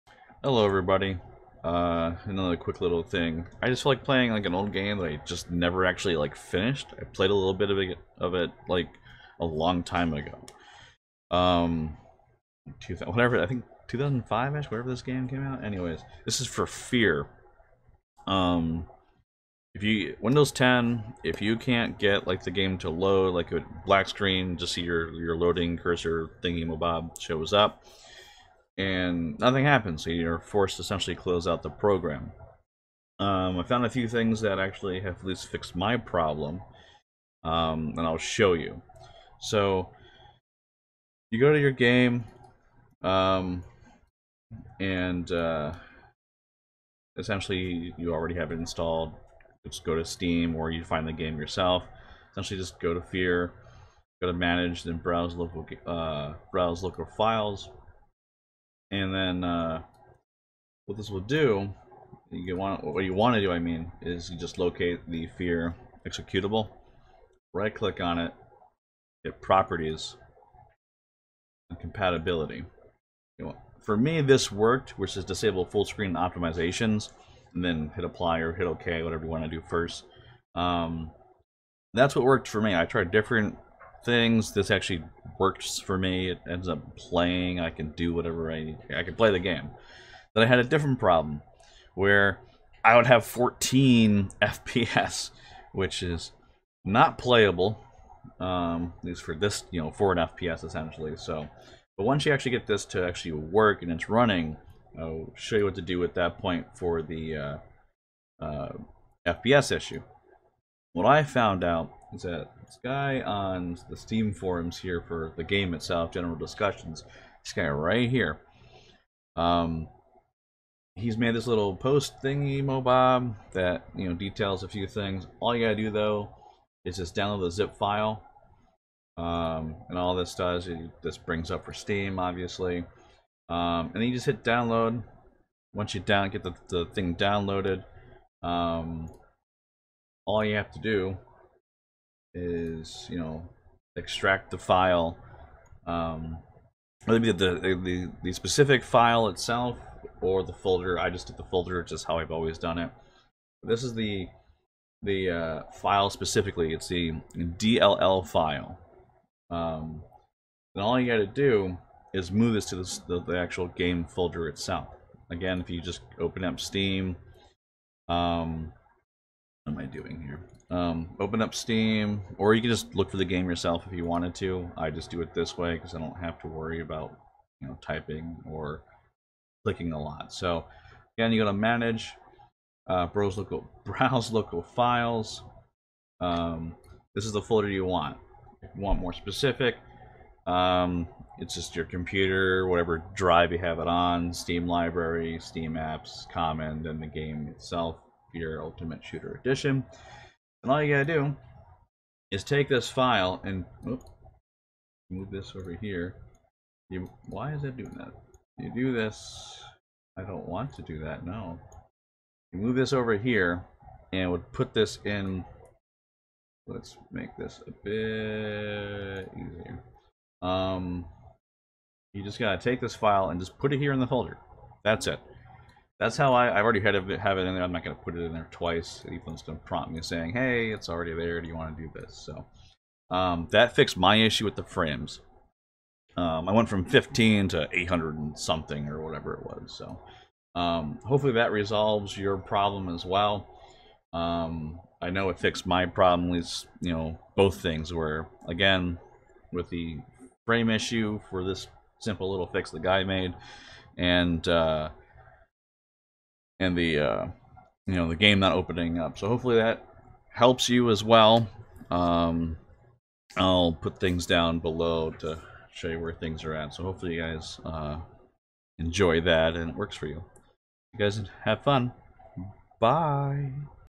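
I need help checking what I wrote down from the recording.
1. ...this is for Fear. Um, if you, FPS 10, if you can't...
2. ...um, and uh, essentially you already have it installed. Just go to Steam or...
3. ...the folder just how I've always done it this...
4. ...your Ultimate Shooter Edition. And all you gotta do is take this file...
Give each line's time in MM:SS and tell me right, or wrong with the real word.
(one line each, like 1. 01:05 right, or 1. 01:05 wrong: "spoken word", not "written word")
1. 00:16 wrong: "Windows", not "FPS"
2. 00:43 right
3. 02:31 right
4. 03:18 right.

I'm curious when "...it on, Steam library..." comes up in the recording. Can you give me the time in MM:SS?
03:13.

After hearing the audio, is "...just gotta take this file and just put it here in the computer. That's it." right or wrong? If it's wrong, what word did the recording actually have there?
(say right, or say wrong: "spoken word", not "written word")
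wrong: "folder", not "computer".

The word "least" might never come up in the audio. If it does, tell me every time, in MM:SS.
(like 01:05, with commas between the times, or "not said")
00:35, 01:39, 04:06.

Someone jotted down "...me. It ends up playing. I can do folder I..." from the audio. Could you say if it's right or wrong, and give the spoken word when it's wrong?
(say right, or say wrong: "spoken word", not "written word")
wrong: "whatever", not "folder".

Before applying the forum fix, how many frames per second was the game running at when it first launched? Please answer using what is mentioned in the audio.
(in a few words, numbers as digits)
14.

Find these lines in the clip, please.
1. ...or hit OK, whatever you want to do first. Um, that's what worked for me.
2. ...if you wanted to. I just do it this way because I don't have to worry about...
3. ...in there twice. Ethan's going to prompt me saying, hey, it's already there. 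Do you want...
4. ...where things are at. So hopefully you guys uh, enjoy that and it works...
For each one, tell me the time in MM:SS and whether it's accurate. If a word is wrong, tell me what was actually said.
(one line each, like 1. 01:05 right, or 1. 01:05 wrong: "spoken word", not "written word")
1. 01:18 right
2. 02:53 right
3. 03:48 right
4. 04:25 right.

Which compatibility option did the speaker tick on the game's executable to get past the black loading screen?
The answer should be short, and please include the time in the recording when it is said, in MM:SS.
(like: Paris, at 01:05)
Disable full screen optimizations, at 01:15.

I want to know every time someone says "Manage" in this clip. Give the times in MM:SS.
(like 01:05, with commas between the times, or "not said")
00:54, 03:01.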